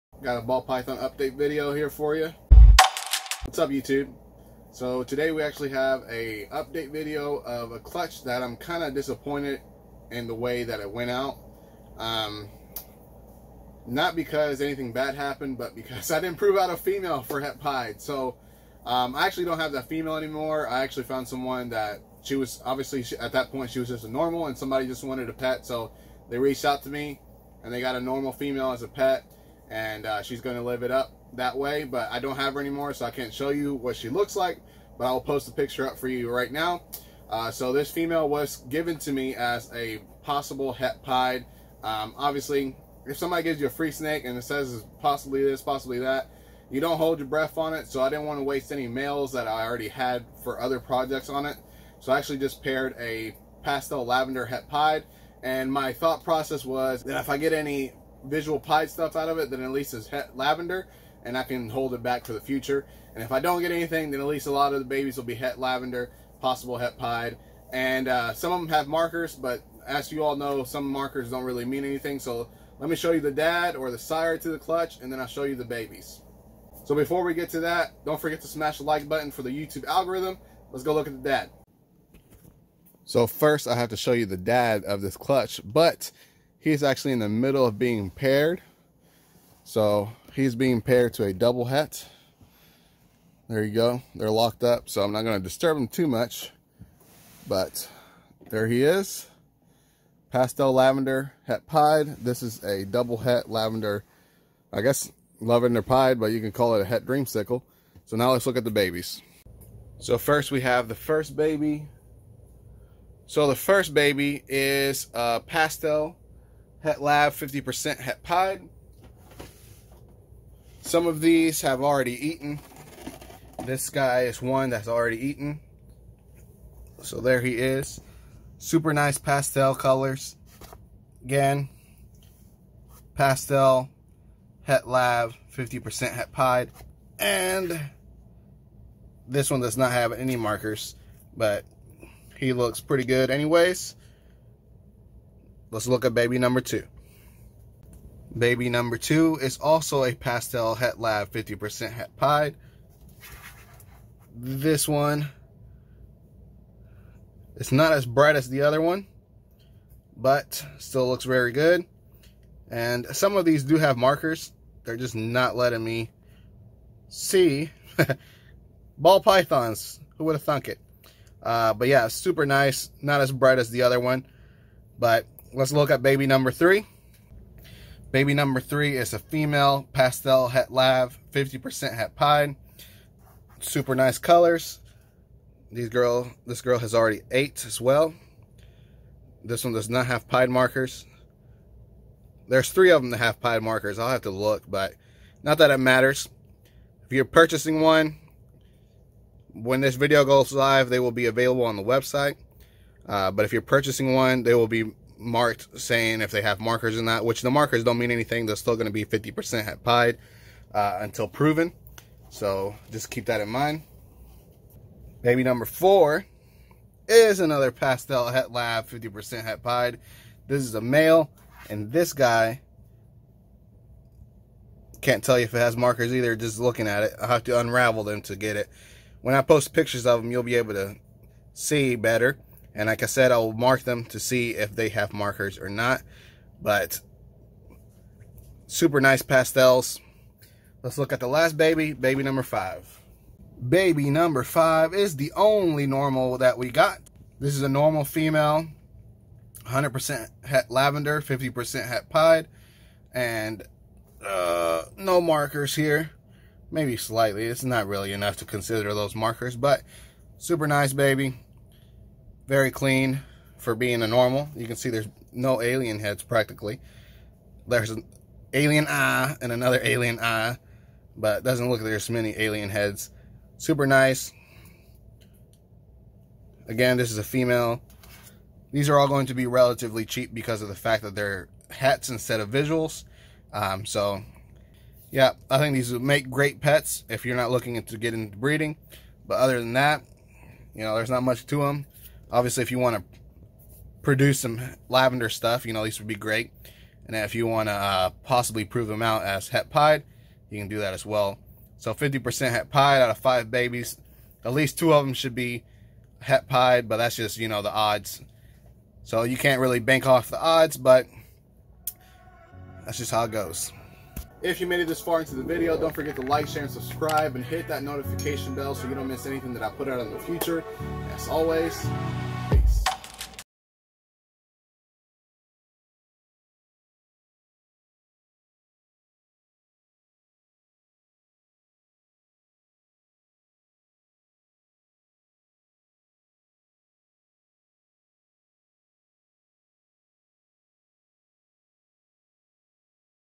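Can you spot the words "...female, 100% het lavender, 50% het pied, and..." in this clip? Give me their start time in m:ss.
4:08.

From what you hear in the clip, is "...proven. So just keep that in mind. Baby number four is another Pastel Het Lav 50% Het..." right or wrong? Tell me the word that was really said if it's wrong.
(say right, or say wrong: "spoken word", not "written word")
right.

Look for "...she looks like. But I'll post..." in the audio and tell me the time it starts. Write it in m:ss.
0:33.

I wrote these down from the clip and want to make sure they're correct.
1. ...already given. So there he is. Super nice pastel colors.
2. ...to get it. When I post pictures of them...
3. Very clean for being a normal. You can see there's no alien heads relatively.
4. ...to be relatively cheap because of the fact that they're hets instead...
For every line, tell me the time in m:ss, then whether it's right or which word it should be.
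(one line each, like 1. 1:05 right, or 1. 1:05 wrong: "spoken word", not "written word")
1. 2:04 wrong: "eaten", not "given"
2. 3:48 right
3. 4:22 wrong: "practically", not "relatively"
4. 4:39 right.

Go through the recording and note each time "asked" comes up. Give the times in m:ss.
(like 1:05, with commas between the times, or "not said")
not said.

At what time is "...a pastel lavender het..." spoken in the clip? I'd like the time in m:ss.
0:52.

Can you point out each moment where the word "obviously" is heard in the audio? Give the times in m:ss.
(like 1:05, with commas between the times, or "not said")
0:22, 0:42, 4:52.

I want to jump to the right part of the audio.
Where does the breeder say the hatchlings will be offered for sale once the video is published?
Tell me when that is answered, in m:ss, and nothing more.
3:21.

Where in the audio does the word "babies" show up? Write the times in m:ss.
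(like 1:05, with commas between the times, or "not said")
1:04, 1:15, 1:48, 5:03.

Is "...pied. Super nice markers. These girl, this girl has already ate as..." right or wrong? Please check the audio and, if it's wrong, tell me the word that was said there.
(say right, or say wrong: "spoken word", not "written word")
wrong: "colors", not "markers".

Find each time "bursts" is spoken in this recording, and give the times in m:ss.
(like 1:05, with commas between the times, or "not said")
not said.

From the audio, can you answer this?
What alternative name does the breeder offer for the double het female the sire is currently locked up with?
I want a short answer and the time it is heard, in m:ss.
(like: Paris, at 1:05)
Het dreamsicle, at 1:46.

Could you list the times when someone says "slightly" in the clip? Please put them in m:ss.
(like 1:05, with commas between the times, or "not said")
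4:16.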